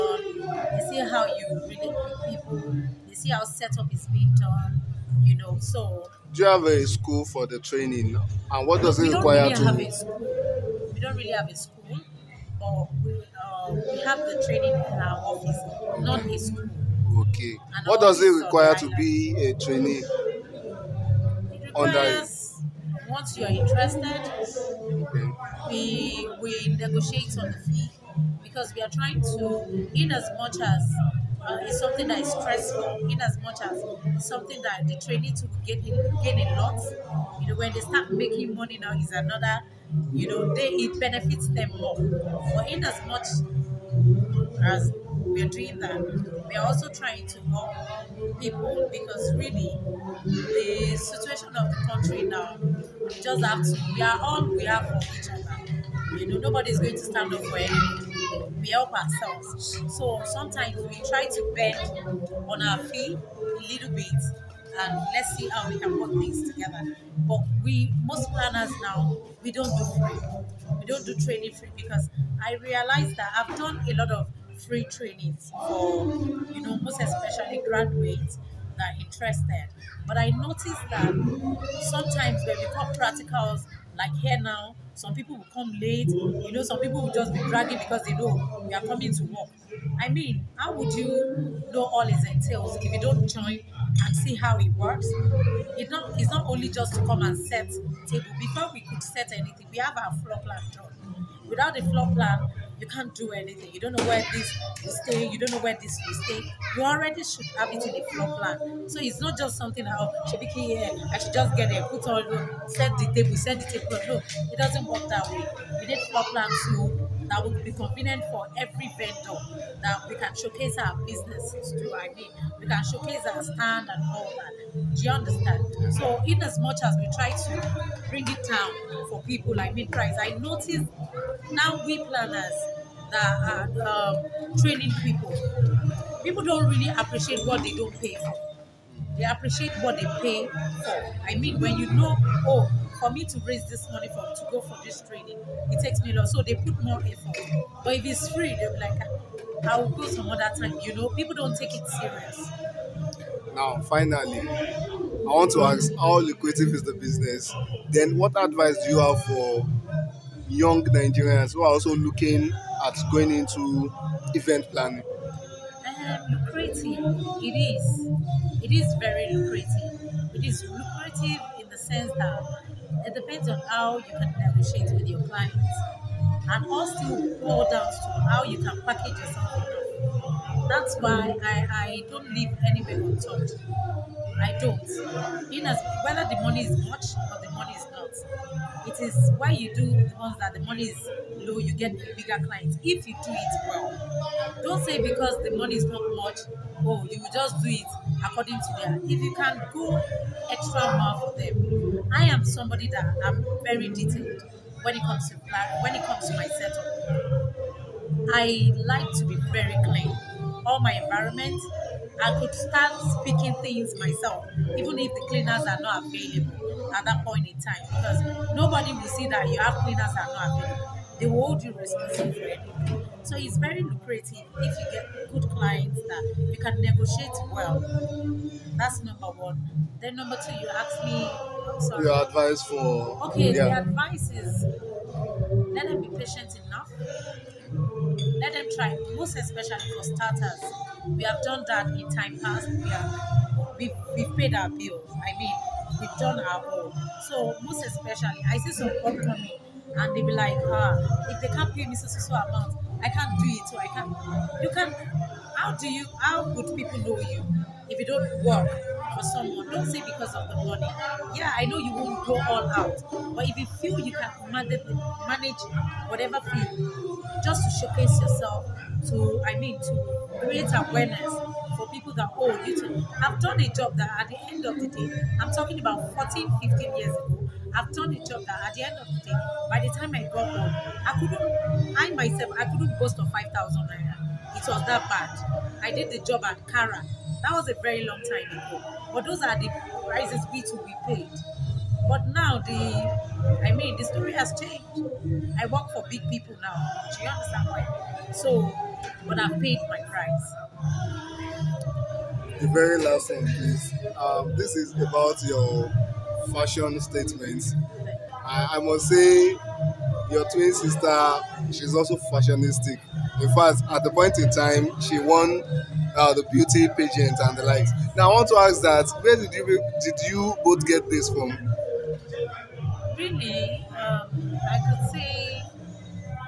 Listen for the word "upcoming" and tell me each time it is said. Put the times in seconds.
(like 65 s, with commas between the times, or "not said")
249 s.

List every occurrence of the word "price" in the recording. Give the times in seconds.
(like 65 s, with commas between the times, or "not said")
129 s, 290 s, 300 s.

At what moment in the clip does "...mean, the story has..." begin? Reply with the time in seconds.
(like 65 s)
293 s.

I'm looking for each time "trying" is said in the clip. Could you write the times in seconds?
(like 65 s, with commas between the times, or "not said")
28 s, 46 s.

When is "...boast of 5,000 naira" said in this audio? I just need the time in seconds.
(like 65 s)
282 s.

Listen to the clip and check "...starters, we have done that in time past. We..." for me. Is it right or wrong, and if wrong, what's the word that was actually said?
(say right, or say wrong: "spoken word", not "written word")
right.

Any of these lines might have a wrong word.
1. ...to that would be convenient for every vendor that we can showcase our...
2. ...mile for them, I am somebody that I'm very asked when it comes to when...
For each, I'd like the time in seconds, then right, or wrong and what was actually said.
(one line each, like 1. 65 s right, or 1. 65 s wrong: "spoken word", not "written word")
1. 116 s right
2. 200 s wrong: "detailed", not "asked".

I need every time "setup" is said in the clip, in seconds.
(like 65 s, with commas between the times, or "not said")
3 s, 206 s.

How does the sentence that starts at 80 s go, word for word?
But I noticed that sometimes when we call practicals, like here now, some people will come late.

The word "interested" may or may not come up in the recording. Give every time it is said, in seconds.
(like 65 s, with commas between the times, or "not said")
23 s, 78 s.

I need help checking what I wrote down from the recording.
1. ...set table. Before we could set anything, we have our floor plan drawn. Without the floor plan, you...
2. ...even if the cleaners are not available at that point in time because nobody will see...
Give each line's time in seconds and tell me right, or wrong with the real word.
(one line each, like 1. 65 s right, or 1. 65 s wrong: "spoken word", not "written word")
1. 97 s right
2. 214 s right.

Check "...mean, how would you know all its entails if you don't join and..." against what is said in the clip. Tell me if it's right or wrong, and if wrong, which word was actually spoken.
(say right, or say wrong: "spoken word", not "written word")
right.